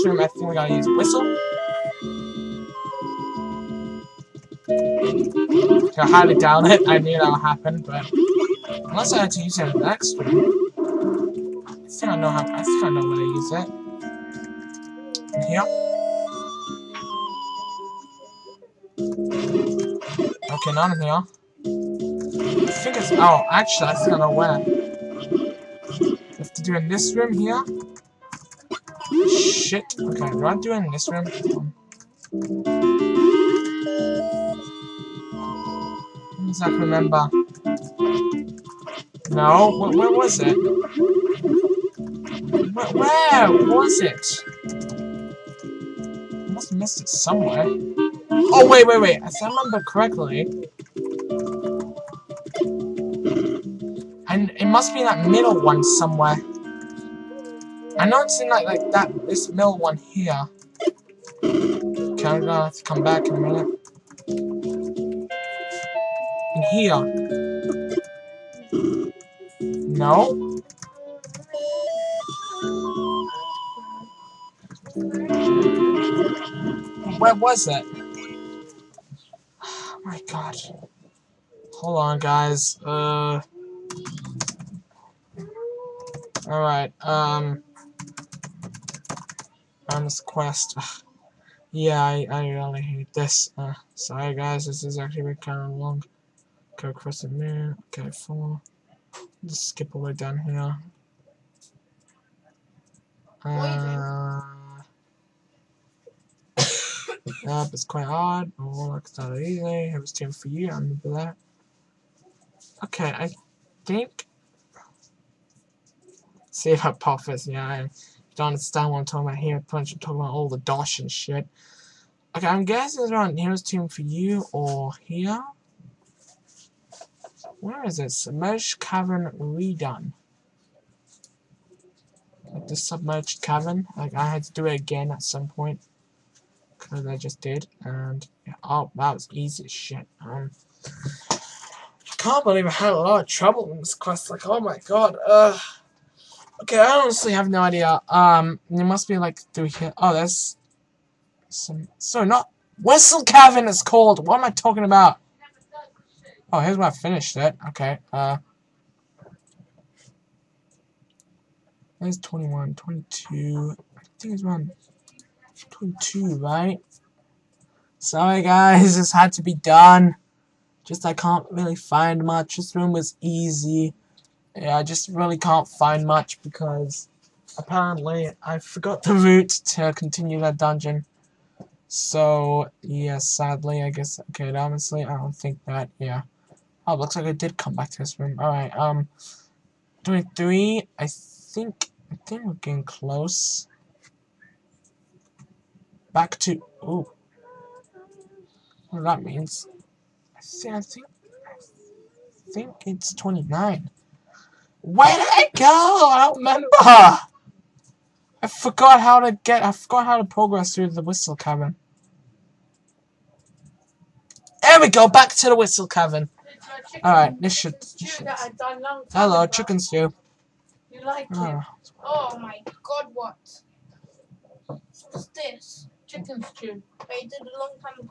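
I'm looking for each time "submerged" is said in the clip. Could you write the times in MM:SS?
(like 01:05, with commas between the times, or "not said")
02:08, 02:12.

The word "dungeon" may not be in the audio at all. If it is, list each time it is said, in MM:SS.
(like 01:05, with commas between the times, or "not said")
03:00.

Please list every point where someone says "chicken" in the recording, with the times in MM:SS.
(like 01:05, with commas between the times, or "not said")
03:39, 03:46.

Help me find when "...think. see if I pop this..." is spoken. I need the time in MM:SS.
01:53.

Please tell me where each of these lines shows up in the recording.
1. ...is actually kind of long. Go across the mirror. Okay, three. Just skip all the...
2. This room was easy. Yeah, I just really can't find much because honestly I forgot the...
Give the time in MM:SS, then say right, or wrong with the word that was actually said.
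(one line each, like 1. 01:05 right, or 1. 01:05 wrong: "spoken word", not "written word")
1. 01:34 wrong: "four", not "three"
2. 02:52 wrong: "apparently", not "honestly".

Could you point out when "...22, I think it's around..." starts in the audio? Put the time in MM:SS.
02:42.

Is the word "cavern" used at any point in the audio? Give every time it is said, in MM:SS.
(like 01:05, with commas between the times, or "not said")
02:08, 02:13, 02:33, 03:31, 03:35.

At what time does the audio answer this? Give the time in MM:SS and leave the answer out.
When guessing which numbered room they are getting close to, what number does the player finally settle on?
03:23.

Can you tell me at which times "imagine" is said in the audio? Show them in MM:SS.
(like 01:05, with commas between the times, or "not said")
not said.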